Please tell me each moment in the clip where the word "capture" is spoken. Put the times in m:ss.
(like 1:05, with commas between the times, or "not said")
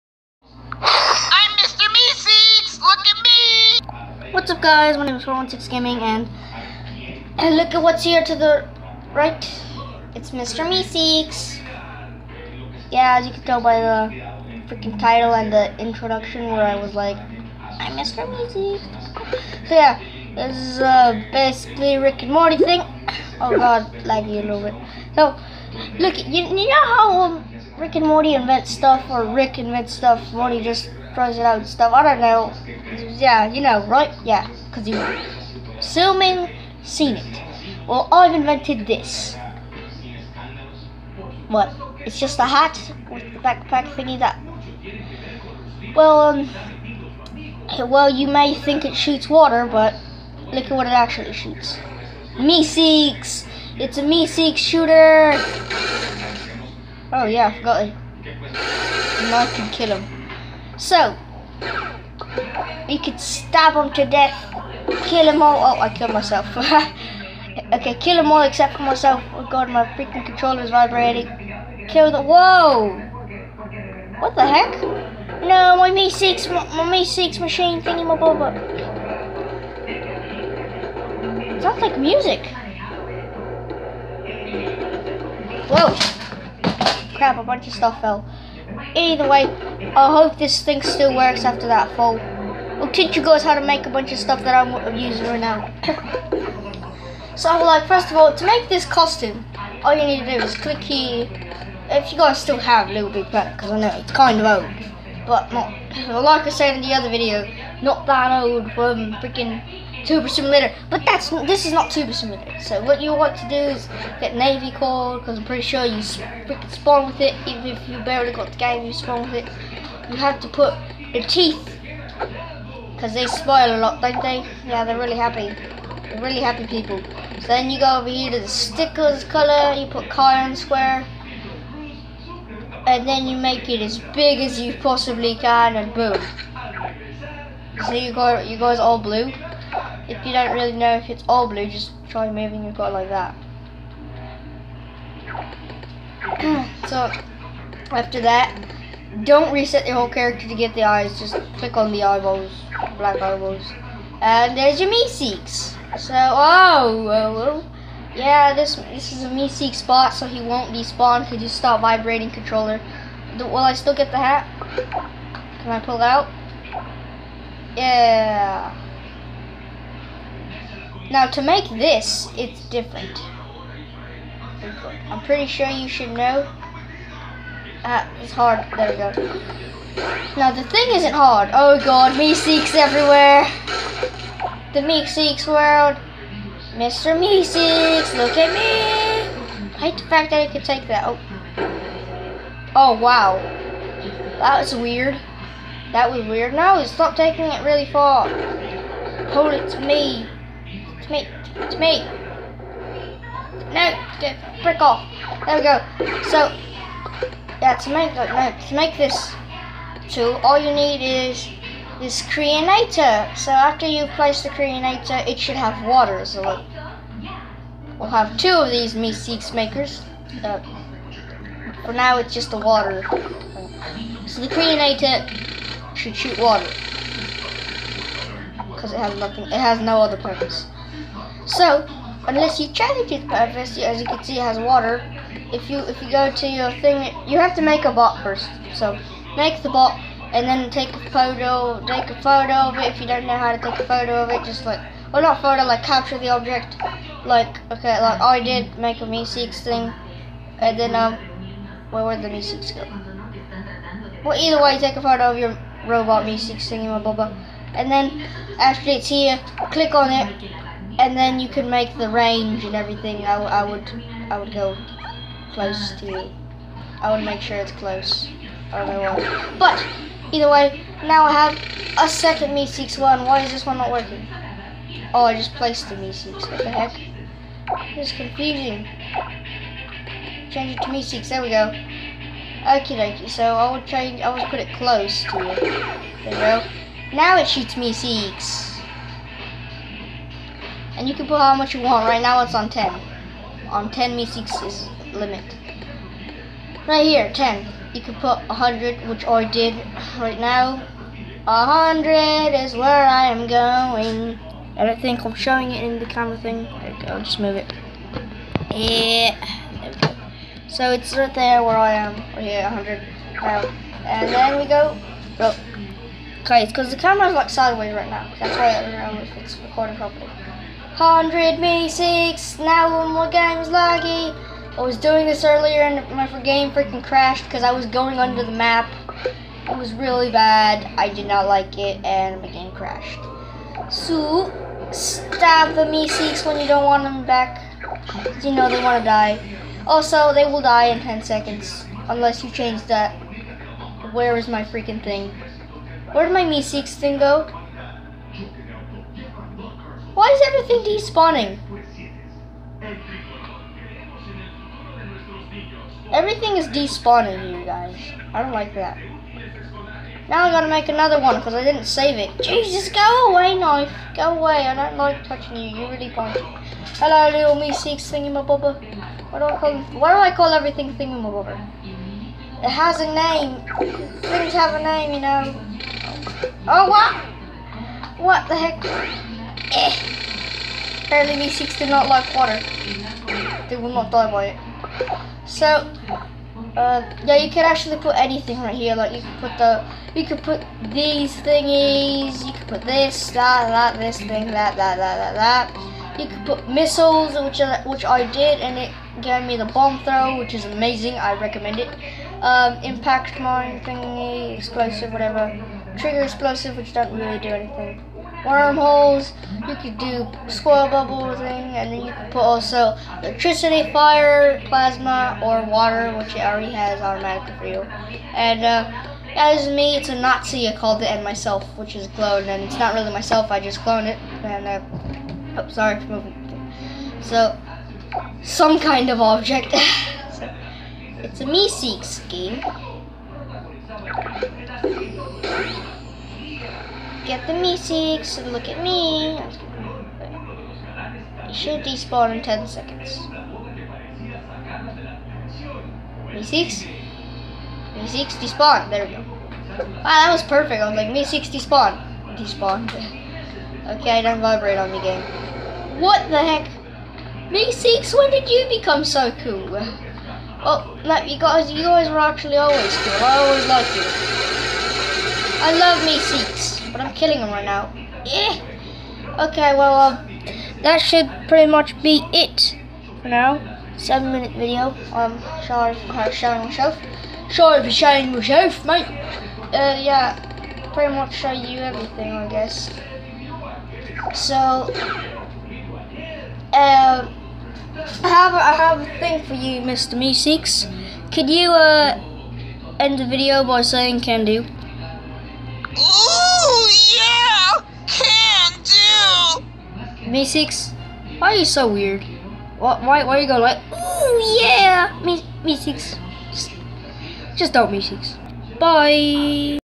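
4:05.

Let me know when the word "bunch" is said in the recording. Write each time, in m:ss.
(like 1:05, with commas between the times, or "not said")
1:27, 1:33.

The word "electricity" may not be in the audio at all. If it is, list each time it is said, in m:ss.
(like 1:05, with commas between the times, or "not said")
6:53.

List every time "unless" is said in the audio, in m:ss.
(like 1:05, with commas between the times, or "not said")
3:52, 5:42.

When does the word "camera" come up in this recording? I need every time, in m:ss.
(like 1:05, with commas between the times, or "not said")
5:06, 5:16.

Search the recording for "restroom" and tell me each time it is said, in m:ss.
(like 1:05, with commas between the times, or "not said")
not said.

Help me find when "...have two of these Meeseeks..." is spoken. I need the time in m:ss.
3:38.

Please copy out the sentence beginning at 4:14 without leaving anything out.
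Well, either way, take a photo of your robot Meeseeks thingy, my blah, blah.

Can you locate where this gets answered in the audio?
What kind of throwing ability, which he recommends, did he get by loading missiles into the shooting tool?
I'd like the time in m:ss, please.
6:39.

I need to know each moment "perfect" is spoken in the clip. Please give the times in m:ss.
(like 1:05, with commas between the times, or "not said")
7:30.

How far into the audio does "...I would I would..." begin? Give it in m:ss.
4:23.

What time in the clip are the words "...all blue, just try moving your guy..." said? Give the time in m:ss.
2:21.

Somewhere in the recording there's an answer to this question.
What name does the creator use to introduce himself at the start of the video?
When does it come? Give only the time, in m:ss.
0:05.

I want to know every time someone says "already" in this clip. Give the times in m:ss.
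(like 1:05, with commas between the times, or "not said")
6:56.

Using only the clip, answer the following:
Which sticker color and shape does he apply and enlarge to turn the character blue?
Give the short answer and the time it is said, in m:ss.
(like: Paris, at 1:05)
cyan square, at 2:10.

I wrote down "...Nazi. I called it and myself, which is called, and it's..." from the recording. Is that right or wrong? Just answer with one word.
wrong.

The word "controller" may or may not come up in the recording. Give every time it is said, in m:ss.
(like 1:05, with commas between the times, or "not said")
1:10, 2:42.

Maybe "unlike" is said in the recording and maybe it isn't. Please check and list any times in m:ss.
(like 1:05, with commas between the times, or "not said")
not said.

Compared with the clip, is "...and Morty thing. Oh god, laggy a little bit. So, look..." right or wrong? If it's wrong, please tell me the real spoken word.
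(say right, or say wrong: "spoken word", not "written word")
right.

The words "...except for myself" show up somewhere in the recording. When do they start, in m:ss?
1:08.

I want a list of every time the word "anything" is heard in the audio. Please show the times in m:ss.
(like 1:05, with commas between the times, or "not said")
6:28, 6:47.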